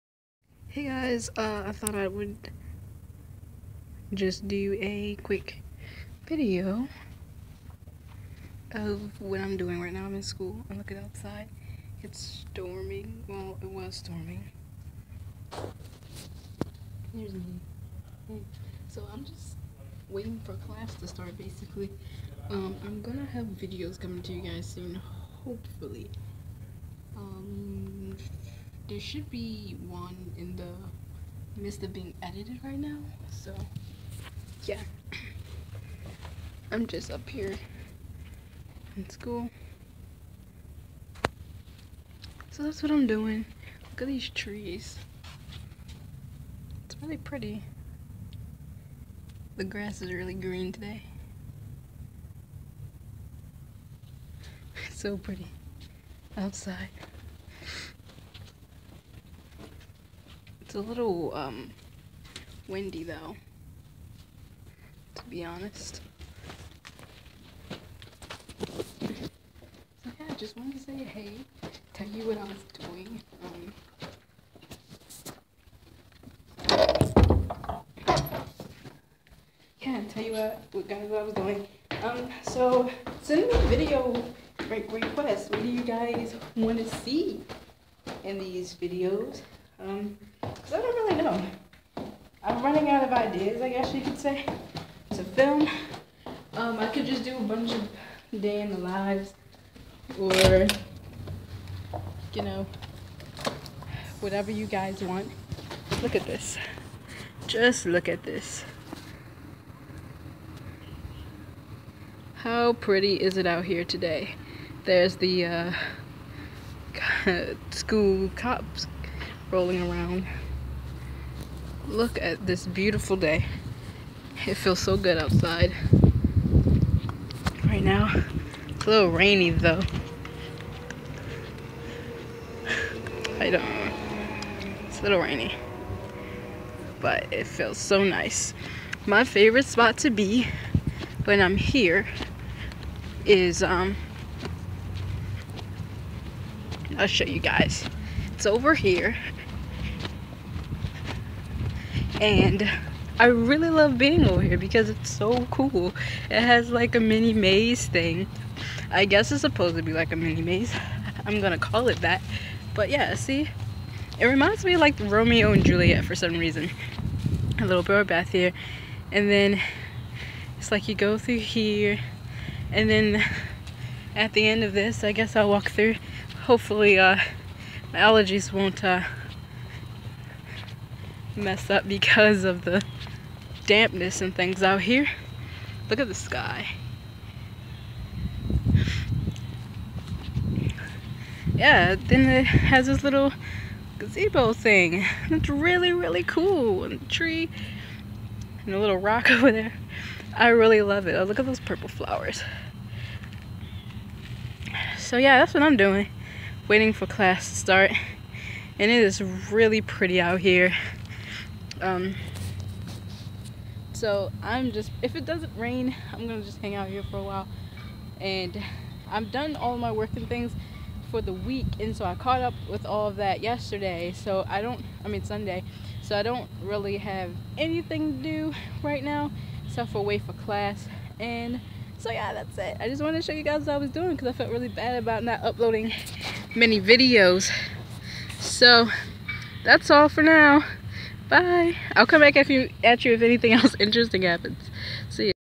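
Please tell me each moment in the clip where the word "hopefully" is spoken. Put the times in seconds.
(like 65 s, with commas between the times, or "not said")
25 s, 176 s.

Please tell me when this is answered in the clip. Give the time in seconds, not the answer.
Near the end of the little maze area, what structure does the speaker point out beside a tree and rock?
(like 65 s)
193 s.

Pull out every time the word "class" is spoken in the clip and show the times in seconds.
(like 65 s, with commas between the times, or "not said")
20 s, 207 s, 230 s.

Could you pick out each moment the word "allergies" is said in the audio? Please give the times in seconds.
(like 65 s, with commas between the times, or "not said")
177 s.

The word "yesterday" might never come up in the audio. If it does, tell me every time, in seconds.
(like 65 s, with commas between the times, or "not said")
223 s.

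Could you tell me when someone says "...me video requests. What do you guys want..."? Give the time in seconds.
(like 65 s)
83 s.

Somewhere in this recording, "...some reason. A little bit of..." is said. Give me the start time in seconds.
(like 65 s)
166 s.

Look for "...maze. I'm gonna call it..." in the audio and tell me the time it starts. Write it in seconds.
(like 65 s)
160 s.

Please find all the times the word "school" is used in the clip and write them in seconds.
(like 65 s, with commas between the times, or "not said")
10 s, 39 s, 117 s.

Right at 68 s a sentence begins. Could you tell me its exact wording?
so yeah, just wanted to say hey, tell you what I was doing.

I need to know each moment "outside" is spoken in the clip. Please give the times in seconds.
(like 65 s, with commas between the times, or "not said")
10 s, 56 s, 125 s.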